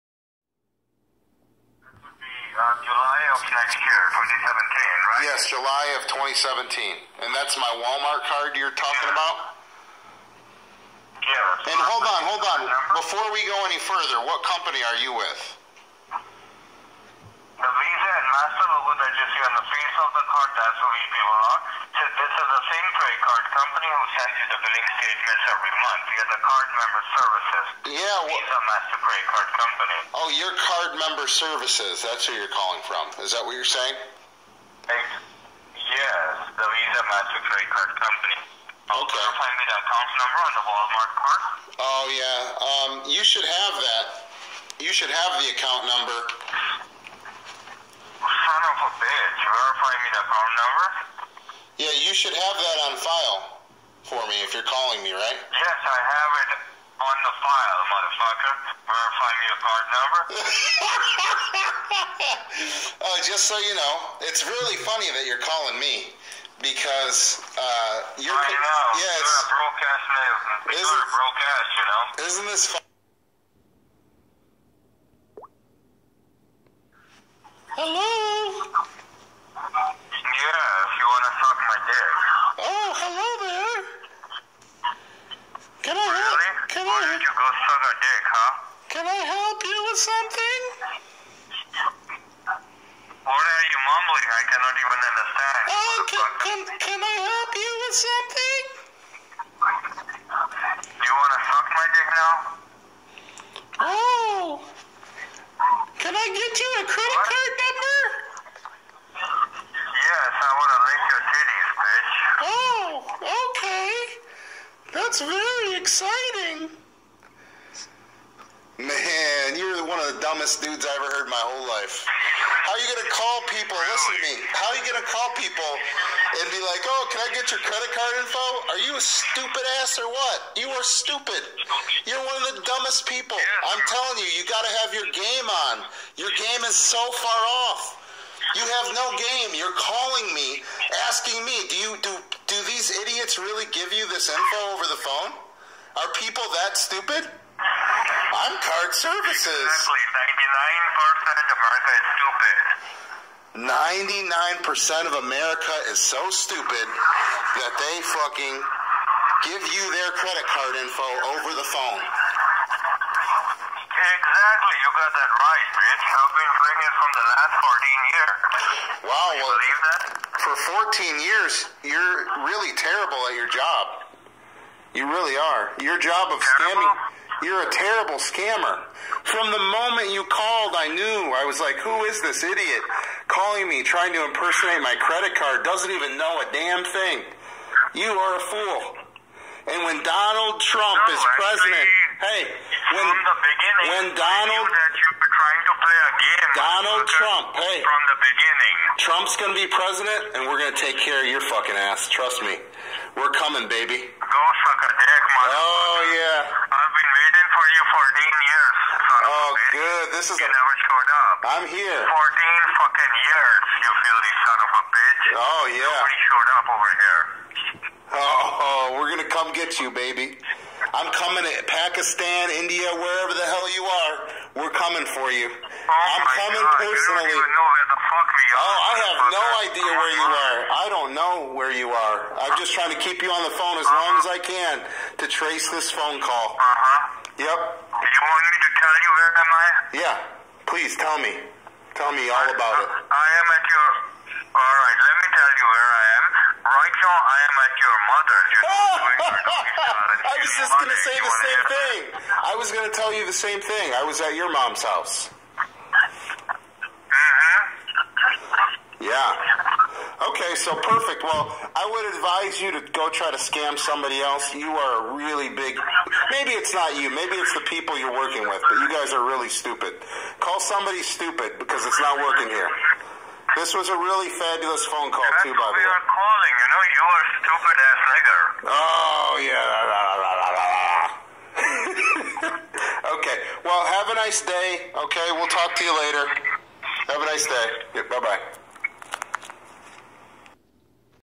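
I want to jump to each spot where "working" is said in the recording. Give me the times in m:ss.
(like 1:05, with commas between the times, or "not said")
4:28, 4:32.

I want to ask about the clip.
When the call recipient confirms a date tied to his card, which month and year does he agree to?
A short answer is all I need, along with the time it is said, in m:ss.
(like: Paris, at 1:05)
July 2017, at 0:05.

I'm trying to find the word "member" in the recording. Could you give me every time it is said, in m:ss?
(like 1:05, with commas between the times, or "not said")
0:26, 0:30.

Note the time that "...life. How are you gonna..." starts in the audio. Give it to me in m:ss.
2:01.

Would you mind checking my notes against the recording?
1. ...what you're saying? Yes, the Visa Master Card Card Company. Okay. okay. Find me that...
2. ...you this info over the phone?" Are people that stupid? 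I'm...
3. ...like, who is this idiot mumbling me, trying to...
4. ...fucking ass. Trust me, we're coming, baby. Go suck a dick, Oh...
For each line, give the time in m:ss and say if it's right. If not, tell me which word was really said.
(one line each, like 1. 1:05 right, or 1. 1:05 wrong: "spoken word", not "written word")
1. 0:33 wrong: "Credit", not "Card"
2. 2:23 right
3. 3:01 wrong: "calling", not "mumbling"
4. 3:21 right.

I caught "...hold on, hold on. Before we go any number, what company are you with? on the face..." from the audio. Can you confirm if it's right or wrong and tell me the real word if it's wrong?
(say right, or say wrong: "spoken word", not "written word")
wrong: "further", not "number".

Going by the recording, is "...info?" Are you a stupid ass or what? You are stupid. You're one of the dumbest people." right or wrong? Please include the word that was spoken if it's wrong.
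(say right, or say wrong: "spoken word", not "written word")
right.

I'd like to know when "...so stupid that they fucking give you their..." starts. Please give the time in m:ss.
2:35.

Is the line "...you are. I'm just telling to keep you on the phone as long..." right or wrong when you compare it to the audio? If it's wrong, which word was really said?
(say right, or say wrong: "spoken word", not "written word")
wrong: "trying", not "telling".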